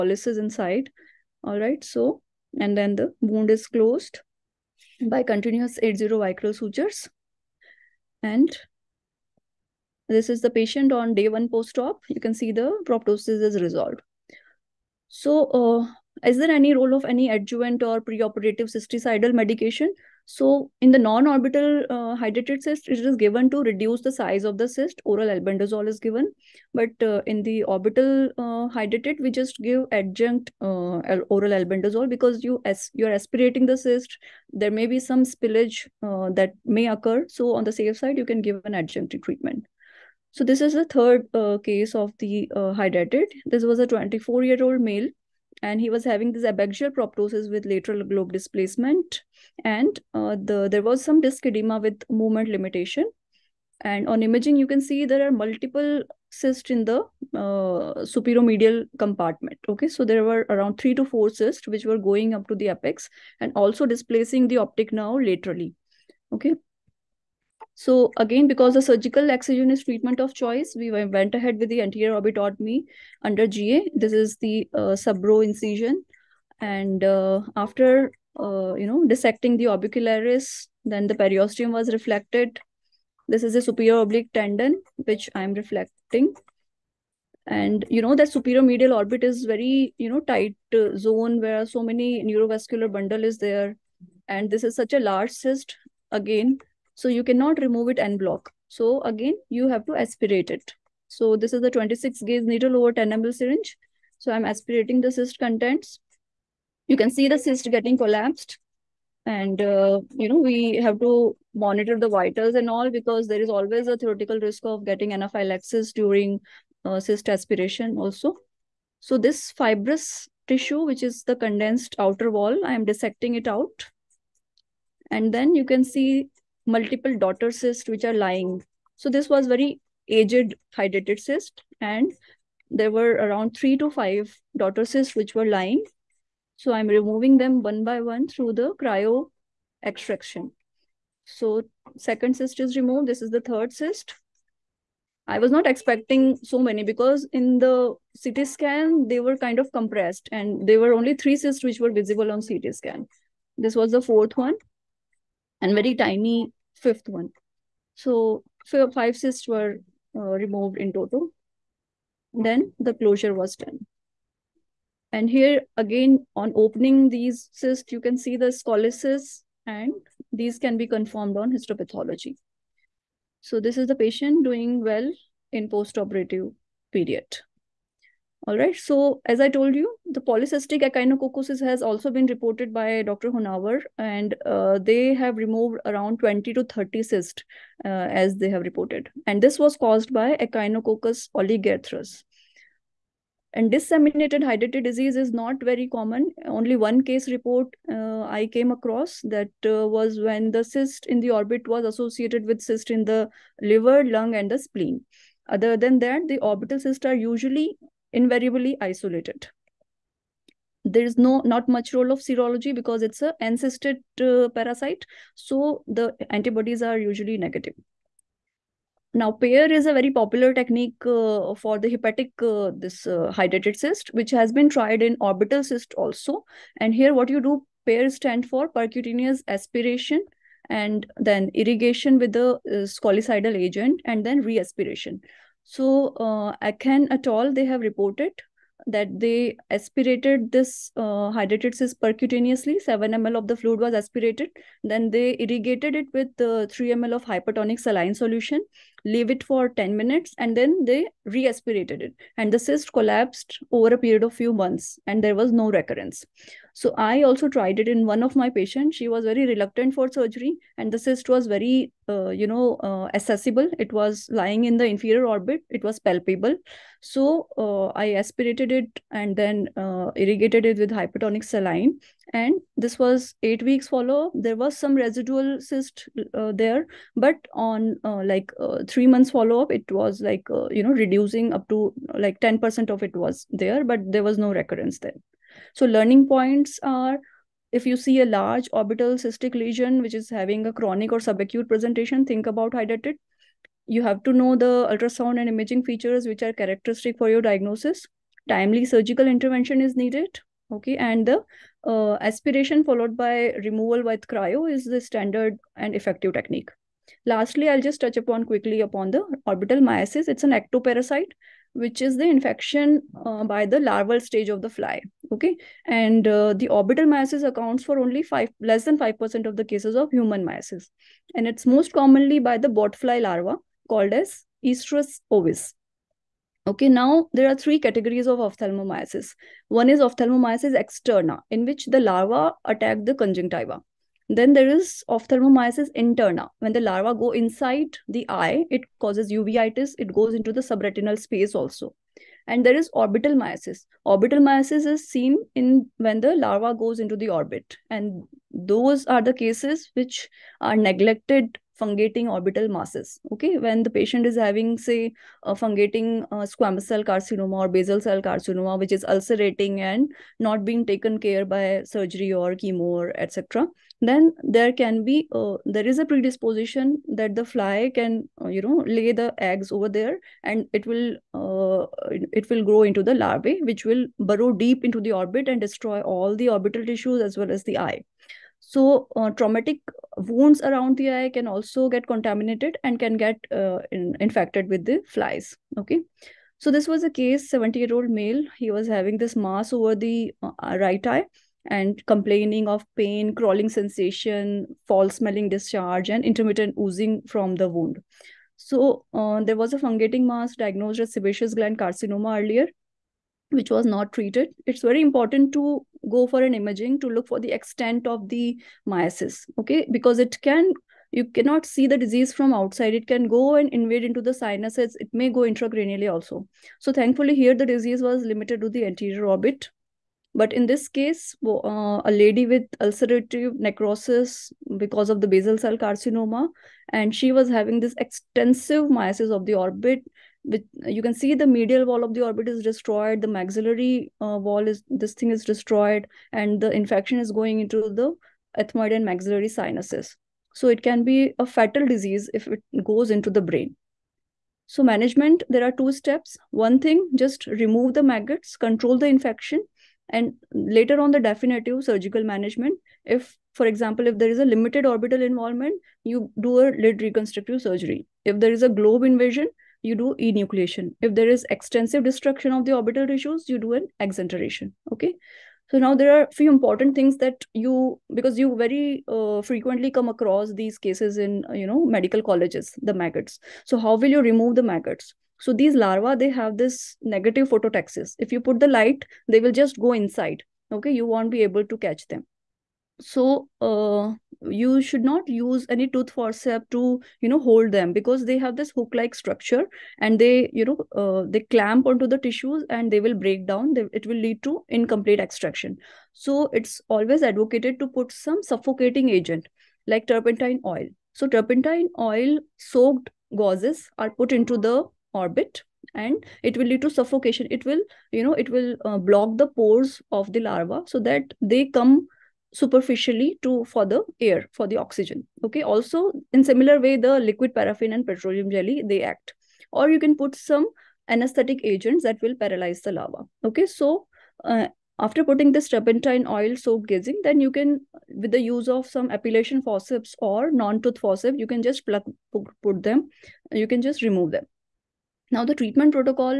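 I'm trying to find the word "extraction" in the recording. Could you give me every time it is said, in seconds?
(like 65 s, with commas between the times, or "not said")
139 s, 495 s.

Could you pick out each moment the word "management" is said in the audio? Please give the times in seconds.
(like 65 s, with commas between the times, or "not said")
444 s, 452 s.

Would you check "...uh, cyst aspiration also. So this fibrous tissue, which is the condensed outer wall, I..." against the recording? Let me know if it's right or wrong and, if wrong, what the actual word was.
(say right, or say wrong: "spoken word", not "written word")
right.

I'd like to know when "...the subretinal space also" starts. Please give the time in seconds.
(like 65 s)
340 s.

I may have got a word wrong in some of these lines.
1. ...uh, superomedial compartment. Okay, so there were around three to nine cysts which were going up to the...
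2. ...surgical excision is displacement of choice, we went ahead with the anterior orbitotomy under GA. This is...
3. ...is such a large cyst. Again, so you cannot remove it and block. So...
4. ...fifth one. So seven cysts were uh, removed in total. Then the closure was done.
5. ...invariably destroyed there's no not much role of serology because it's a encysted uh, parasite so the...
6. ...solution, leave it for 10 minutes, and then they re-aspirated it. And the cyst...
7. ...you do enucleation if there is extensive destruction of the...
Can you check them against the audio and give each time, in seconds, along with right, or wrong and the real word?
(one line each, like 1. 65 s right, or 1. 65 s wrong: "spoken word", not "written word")
1. 57 s wrong: "four", not "nine"
2. 68 s wrong: "treatment", not "displacement"
3. 94 s right
4. 156 s wrong: "five", not "seven"
5. 208 s wrong: "isolated", not "destroyed"
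6. 248 s right
7. 459 s right.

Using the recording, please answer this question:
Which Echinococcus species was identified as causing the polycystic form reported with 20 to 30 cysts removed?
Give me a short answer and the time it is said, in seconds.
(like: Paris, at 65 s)
Echinococcus oligarthrus, at 190 s.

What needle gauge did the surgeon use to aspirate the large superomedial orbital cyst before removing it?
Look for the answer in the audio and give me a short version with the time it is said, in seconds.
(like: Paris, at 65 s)
26 gauge, at 101 s.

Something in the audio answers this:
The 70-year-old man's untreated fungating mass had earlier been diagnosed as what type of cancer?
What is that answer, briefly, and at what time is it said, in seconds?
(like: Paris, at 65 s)
Sebaceous gland carcinoma, at 401 s.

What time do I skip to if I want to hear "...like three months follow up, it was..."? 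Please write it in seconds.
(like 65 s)
278 s.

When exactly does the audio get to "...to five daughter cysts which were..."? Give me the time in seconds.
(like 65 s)
133 s.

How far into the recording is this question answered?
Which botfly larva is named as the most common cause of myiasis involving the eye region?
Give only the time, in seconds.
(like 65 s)
324 s.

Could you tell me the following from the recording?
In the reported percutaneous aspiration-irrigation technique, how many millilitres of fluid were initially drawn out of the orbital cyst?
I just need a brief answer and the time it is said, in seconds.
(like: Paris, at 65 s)
7 ml, at 242 s.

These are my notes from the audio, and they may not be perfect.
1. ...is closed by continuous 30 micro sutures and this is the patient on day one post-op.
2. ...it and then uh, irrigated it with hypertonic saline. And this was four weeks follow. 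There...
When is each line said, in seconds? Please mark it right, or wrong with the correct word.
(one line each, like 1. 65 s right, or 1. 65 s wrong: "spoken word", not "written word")
1. 3 s wrong: "80", not "30"
2. 268 s wrong: "eight", not "four".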